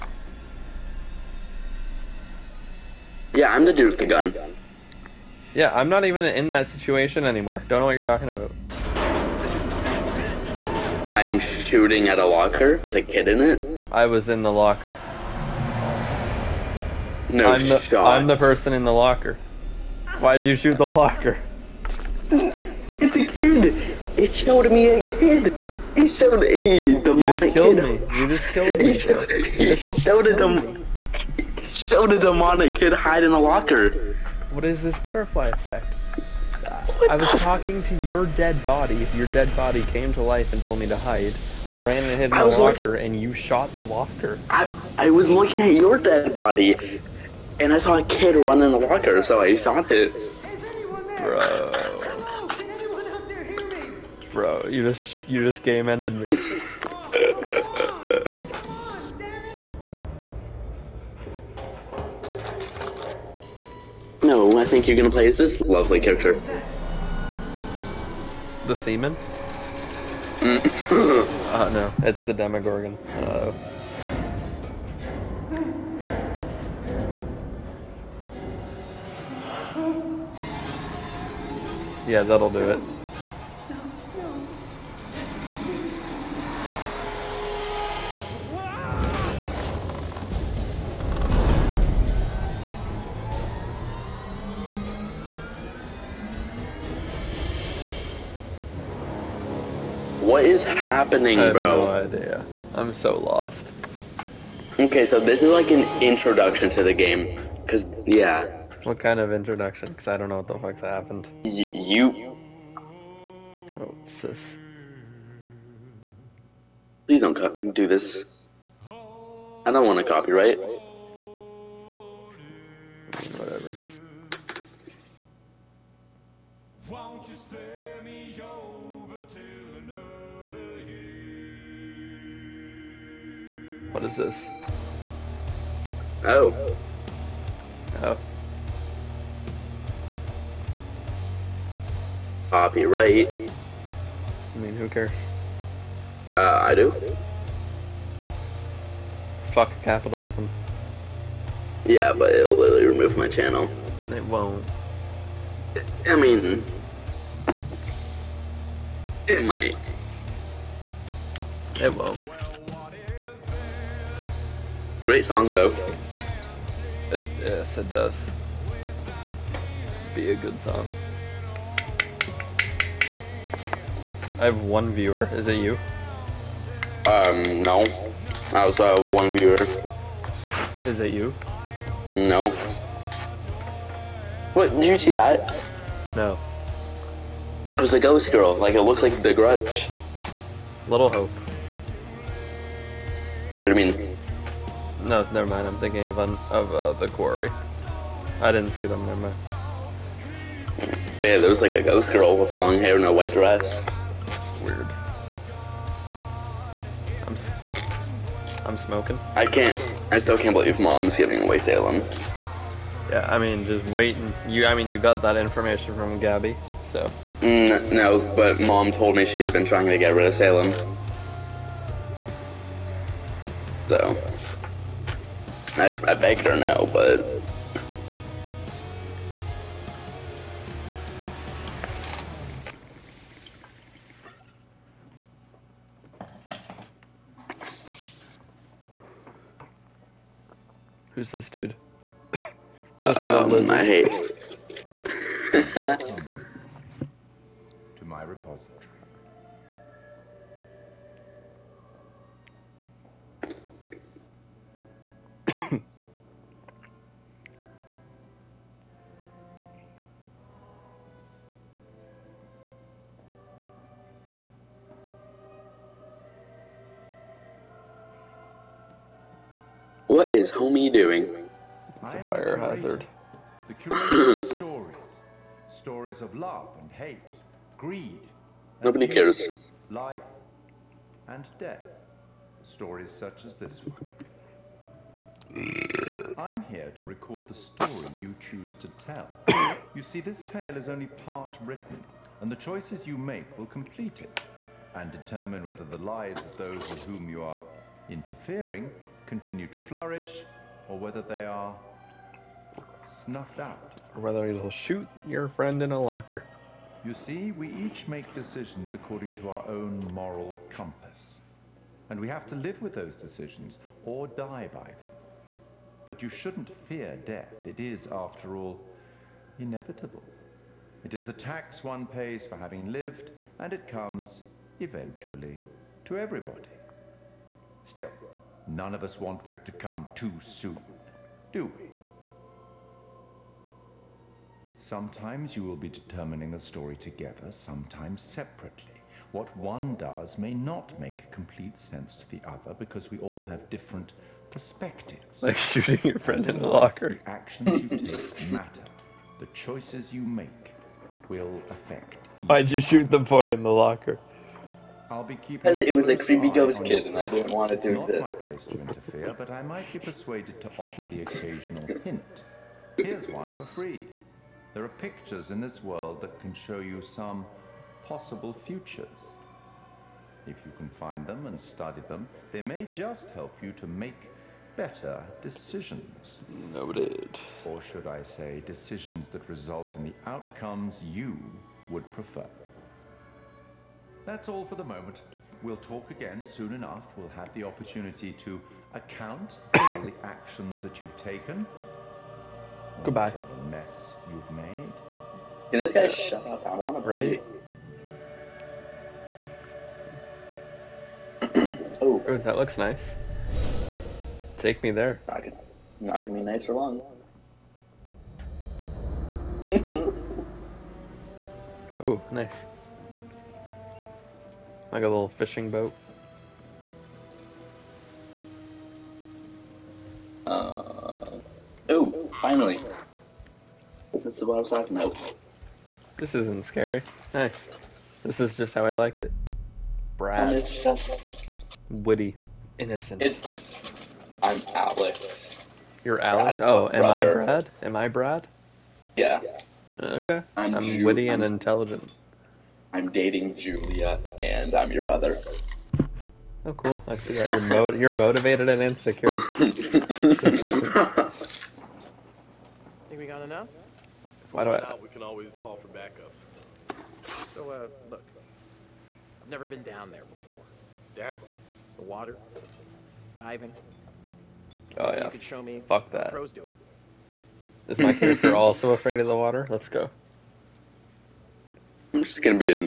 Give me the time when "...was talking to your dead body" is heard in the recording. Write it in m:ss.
0:37.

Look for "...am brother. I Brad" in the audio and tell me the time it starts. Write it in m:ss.
7:16.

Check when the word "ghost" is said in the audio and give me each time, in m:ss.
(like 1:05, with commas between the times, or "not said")
3:07, 3:21, 5:56.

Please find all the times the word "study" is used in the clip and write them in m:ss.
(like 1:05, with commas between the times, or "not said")
6:11.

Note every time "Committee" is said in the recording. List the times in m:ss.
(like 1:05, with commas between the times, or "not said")
not said.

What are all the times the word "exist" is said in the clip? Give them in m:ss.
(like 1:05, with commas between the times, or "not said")
5:58.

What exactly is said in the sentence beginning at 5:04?
Or whether you'll shoot your friend in a locker.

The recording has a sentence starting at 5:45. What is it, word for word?
Like shooting your friend in the locker.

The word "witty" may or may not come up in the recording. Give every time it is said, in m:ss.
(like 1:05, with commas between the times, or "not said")
7:11, 7:21.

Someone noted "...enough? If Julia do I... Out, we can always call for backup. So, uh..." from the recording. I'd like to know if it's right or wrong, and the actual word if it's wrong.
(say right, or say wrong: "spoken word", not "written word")
wrong: "Why", not "Julia".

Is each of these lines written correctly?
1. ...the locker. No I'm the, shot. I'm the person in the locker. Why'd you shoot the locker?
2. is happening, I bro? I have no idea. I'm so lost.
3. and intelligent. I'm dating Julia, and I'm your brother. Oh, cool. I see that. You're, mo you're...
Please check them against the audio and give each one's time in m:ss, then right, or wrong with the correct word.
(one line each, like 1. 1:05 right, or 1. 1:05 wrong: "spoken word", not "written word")
1. 0:14 right
2. 1:40 right
3. 7:21 right.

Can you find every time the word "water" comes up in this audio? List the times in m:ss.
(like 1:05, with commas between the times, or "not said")
7:42, 7:49.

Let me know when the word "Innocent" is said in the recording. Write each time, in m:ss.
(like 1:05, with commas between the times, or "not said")
7:12.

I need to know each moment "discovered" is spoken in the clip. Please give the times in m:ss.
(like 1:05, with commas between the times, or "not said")
not said.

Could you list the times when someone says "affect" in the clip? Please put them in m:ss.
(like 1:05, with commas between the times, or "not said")
5:51.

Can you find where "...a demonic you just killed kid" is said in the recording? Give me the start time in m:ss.
0:26.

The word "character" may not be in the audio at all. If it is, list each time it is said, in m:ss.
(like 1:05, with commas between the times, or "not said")
1:06, 7:48.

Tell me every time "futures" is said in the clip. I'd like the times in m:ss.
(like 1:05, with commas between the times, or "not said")
6:08.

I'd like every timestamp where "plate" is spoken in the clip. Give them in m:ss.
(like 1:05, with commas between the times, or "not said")
not said.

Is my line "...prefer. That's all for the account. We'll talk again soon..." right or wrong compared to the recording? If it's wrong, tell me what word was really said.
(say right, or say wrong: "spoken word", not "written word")
wrong: "moment", not "account".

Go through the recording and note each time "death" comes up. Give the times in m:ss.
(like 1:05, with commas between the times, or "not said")
4:41, 5:17.